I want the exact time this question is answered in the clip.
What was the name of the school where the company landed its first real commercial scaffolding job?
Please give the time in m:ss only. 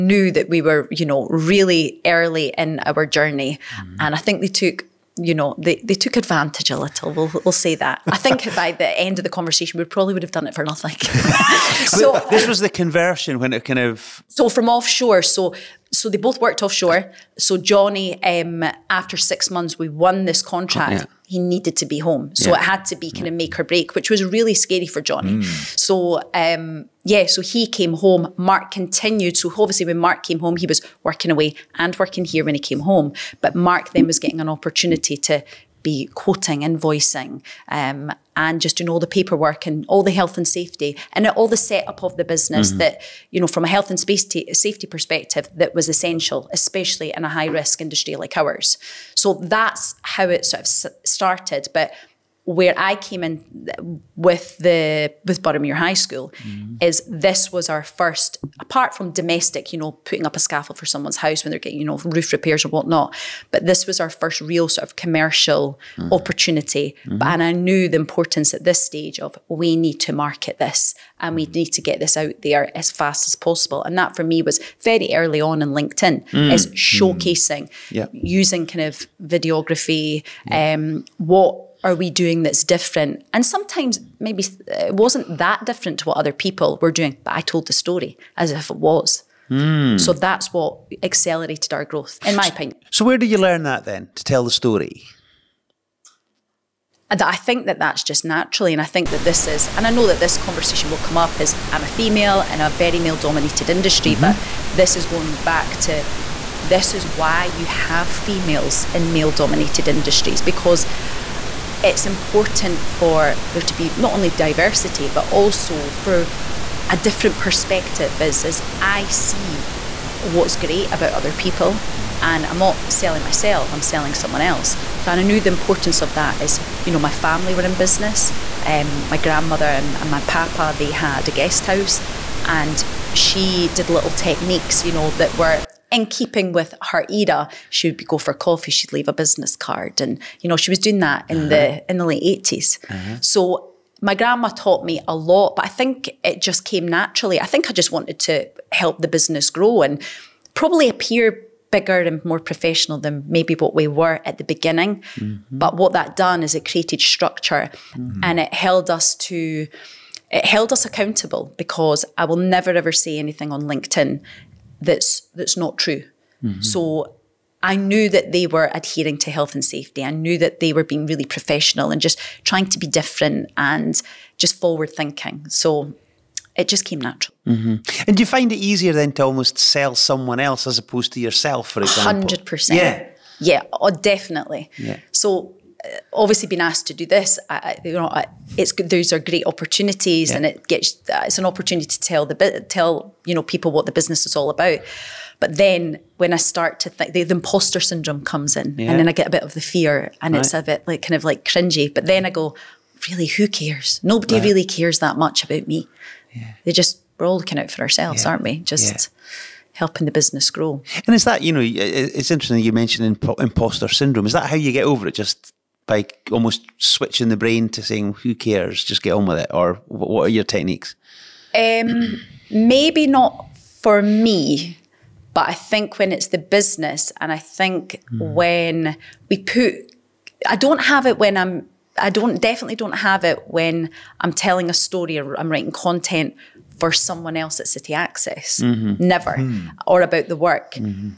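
0:55.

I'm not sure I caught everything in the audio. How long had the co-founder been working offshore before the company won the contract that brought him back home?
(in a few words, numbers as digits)
6 months.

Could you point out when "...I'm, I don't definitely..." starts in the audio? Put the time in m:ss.
3:51.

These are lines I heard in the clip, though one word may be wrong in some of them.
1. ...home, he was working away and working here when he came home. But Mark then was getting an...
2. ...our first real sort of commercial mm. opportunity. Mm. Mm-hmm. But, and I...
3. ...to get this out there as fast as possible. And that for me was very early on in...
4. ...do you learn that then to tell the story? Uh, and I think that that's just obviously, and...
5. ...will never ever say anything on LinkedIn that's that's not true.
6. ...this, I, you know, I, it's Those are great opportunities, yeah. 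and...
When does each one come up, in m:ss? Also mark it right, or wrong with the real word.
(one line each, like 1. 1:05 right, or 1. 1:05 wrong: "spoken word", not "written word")
1. 0:30 right
2. 1:04 right
3. 1:11 right
4. 1:33 wrong: "naturally", not "obviously"
5. 2:42 right
6. 3:07 right.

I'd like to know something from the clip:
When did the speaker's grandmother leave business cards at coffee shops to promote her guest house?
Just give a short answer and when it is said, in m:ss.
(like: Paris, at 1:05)
late 80s, at 2:22.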